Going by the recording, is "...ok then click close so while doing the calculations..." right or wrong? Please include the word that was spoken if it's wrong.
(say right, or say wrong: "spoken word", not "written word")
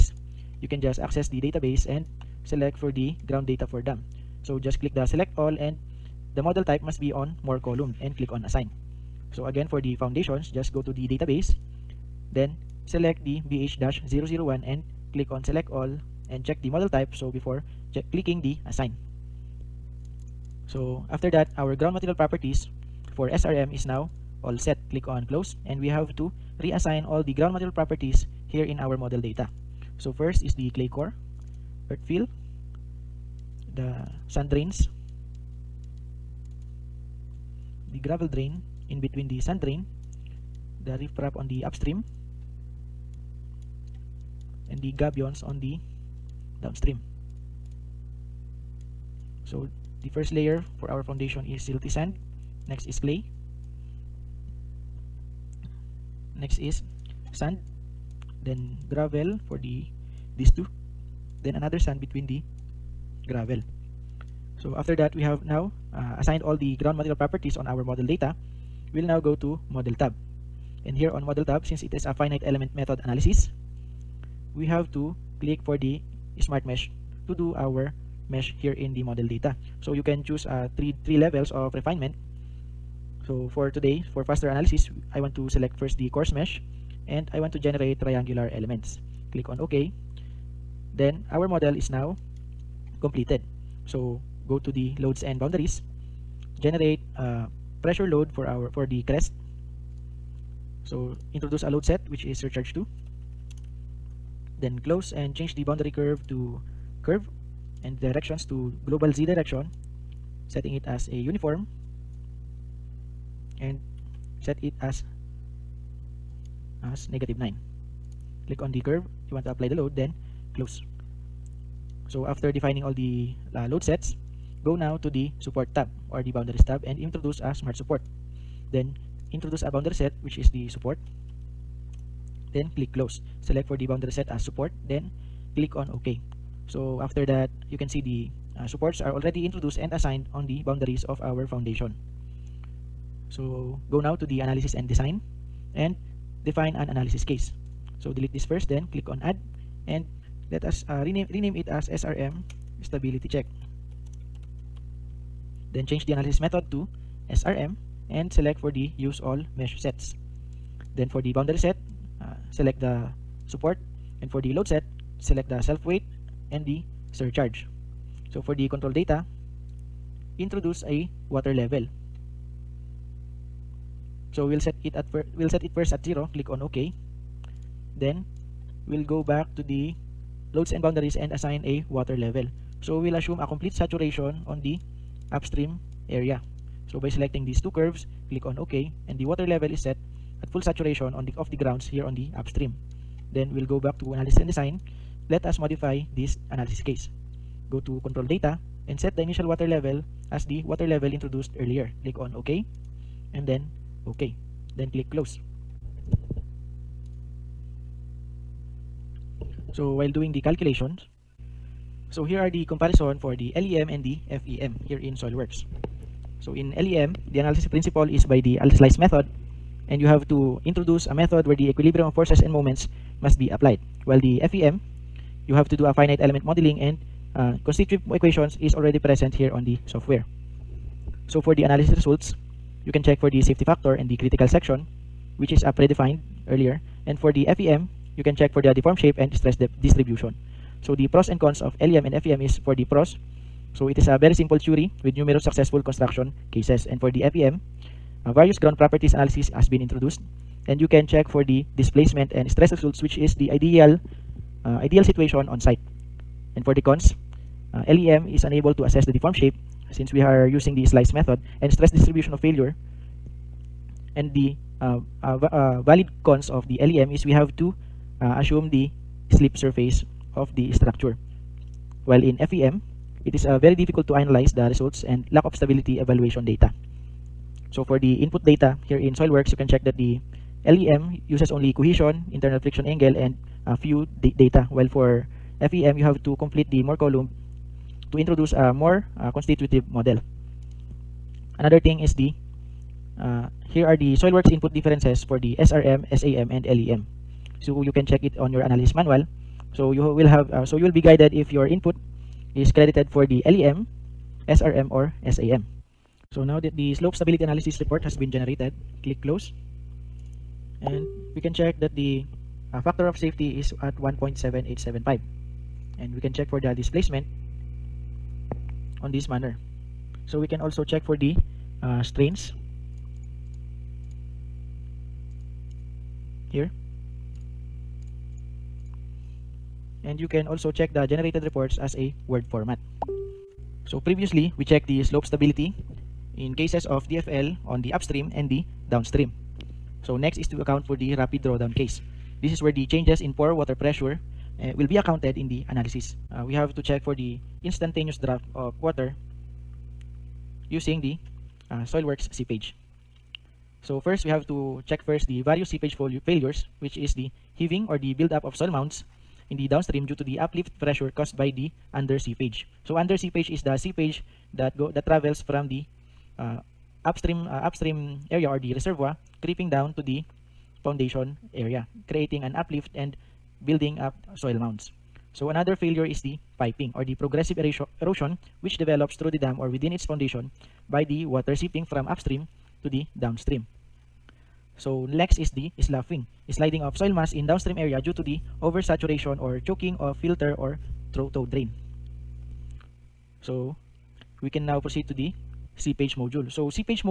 right.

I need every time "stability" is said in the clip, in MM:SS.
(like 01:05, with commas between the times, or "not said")
02:32, 04:35, 05:07, 05:35.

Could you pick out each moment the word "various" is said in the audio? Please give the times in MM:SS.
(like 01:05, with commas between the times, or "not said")
04:08, 05:55.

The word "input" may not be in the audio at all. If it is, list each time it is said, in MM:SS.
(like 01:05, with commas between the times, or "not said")
04:38, 04:54, 05:01.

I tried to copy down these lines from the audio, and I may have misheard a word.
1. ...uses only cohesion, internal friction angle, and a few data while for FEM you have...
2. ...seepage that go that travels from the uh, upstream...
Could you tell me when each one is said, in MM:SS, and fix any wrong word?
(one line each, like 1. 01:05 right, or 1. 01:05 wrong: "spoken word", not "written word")
1. 04:41 right
2. 06:03 right.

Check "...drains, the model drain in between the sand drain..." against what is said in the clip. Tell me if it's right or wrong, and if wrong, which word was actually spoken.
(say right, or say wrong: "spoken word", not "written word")
wrong: "gravel", not "model".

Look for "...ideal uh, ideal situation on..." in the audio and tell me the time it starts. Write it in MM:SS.
04:13.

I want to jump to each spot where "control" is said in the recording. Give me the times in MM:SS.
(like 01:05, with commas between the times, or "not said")
02:48, 03:18.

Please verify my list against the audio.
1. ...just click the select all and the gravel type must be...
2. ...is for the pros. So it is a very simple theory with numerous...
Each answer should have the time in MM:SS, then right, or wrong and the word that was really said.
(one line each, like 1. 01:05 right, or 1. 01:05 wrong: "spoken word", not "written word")
1. 00:04 wrong: "model", not "gravel"
2. 04:02 right.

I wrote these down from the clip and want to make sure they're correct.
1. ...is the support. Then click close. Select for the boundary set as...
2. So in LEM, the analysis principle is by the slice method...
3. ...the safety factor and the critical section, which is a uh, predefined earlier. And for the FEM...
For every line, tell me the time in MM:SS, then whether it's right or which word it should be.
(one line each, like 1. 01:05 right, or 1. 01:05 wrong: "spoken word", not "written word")
1. 02:10 right
2. 03:36 right
3. 03:53 right.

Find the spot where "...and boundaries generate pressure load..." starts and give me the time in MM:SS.
01:35.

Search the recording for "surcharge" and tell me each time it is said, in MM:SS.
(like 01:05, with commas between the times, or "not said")
01:42, 02:47.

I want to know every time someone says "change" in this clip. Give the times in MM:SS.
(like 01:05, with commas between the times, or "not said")
01:45, 02:35, 05:42.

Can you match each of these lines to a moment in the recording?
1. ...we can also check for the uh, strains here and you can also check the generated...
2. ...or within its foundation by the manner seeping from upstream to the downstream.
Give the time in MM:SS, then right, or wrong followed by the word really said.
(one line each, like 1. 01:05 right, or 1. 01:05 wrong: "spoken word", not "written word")
1. 05:20 right
2. 06:19 wrong: "water", not "manner".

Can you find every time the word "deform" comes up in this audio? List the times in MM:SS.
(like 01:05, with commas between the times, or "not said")
03:58, 04:19.